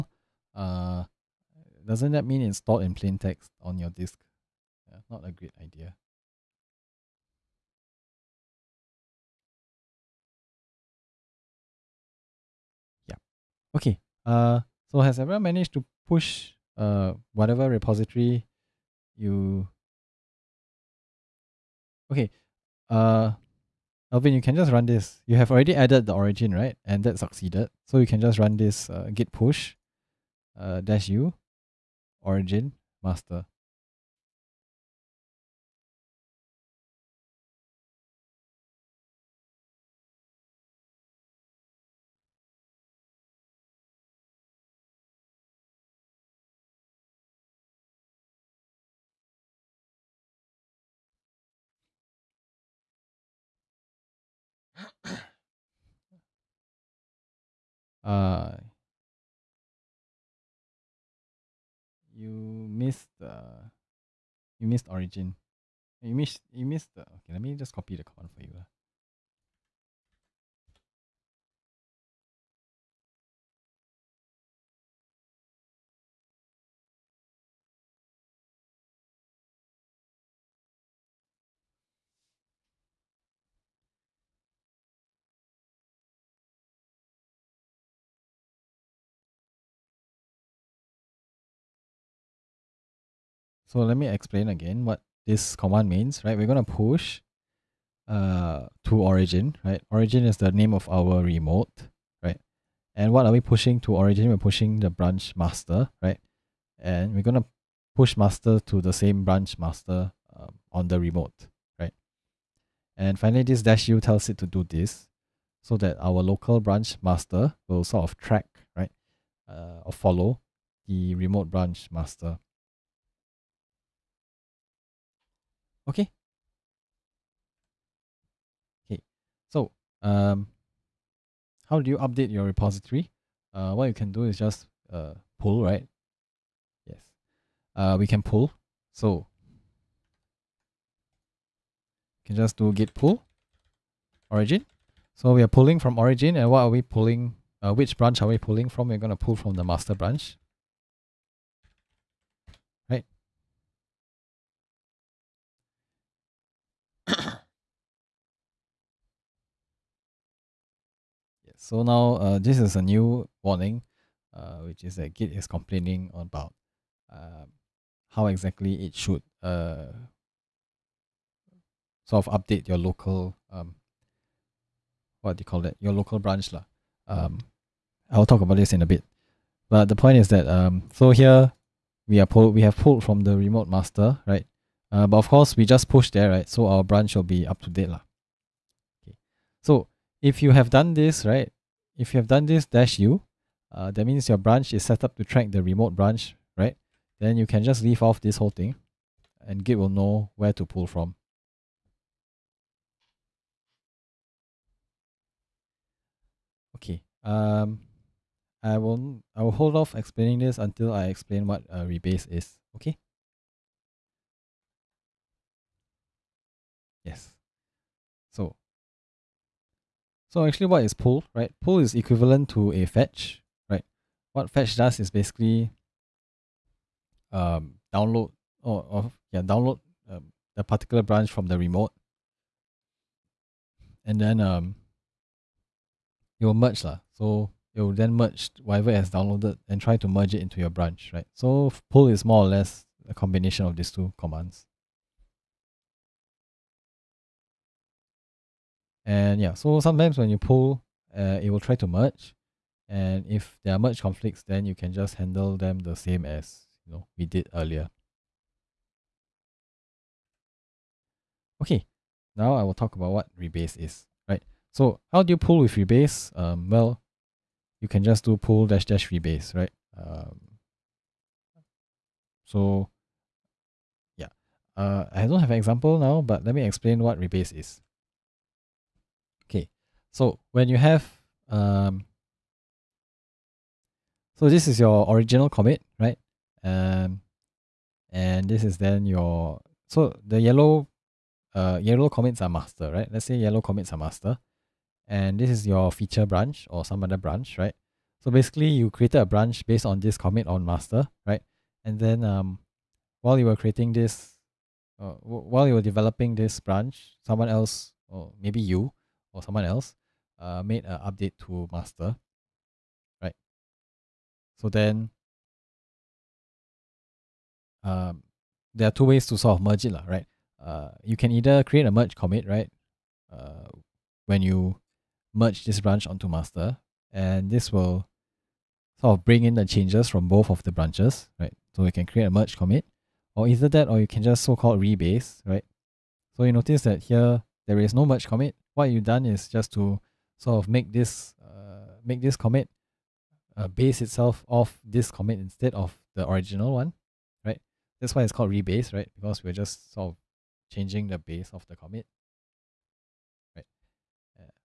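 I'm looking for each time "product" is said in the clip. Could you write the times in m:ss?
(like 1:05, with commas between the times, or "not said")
not said.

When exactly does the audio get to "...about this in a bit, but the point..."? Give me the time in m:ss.
2:58.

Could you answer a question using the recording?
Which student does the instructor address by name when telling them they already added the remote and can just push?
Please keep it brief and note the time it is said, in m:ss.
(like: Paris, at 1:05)
Alvin, at 0:24.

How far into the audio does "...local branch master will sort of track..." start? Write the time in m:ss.
1:56.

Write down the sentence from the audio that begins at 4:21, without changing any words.
Okay, now I will talk about what rebase is, right?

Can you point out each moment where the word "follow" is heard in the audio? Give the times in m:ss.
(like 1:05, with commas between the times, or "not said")
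1:59.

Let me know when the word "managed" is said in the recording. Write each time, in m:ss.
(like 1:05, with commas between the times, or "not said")
0:15.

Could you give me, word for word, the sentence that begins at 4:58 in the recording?
So basically you created a branch based on this commit on master, right?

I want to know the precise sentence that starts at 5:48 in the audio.
That's why it's called rebase, right?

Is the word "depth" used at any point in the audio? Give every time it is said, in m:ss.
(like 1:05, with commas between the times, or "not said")
not said.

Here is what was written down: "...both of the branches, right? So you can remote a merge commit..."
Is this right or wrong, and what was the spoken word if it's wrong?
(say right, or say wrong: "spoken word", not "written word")
wrong: "create", not "remote".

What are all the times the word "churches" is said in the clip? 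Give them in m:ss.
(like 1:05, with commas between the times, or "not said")
not said.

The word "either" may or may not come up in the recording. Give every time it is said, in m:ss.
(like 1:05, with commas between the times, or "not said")
5:21, 5:33.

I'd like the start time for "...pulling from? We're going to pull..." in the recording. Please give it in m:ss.
2:28.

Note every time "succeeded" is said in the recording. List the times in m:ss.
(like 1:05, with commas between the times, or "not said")
0:27.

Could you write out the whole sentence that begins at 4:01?
So pull is more or less a combination of these two commands.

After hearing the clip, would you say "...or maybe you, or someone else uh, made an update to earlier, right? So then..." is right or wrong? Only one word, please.
wrong.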